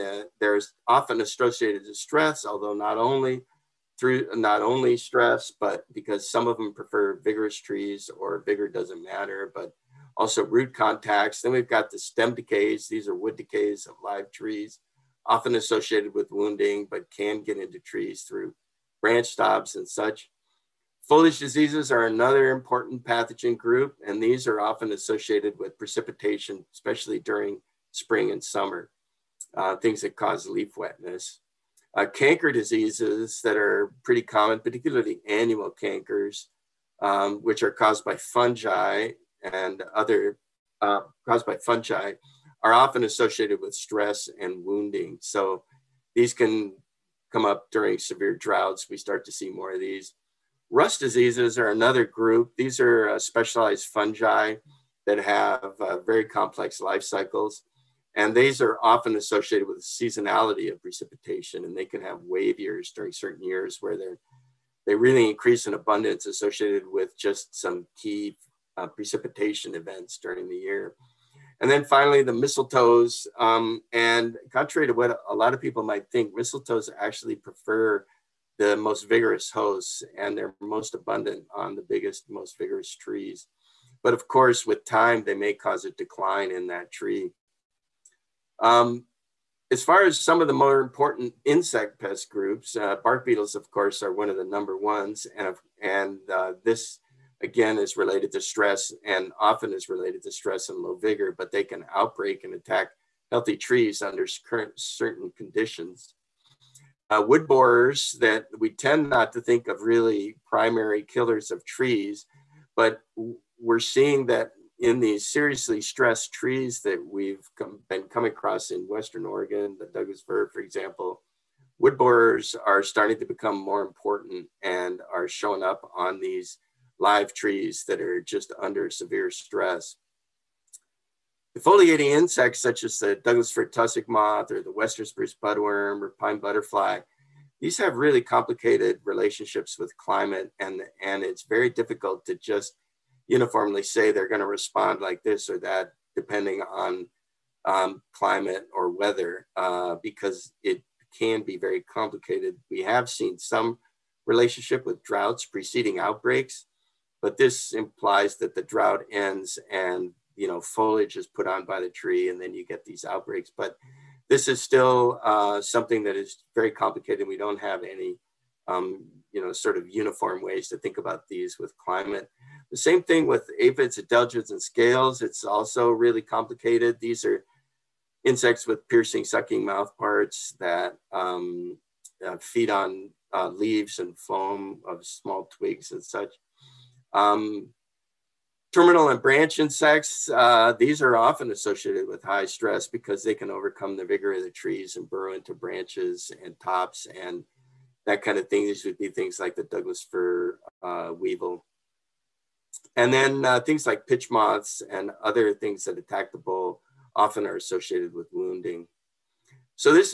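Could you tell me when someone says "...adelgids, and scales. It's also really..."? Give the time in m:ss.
2:53.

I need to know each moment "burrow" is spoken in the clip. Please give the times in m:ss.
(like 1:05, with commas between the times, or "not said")
3:15.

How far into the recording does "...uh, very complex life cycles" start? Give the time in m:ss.
0:55.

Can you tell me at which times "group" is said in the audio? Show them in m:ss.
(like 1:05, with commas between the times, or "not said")
0:23, 0:52, 1:32.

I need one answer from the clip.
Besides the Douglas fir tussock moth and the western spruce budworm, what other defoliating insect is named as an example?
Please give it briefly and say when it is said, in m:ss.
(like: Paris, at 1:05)
Pine butterfly, at 2:16.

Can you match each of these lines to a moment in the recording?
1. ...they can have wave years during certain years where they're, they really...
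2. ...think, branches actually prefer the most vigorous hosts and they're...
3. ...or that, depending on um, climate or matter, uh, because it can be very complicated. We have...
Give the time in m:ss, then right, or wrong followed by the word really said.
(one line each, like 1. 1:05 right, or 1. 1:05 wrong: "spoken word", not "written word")
1. 1:01 right
2. 1:16 wrong: "mistletoes", not "branches"
3. 2:25 wrong: "weather", not "matter".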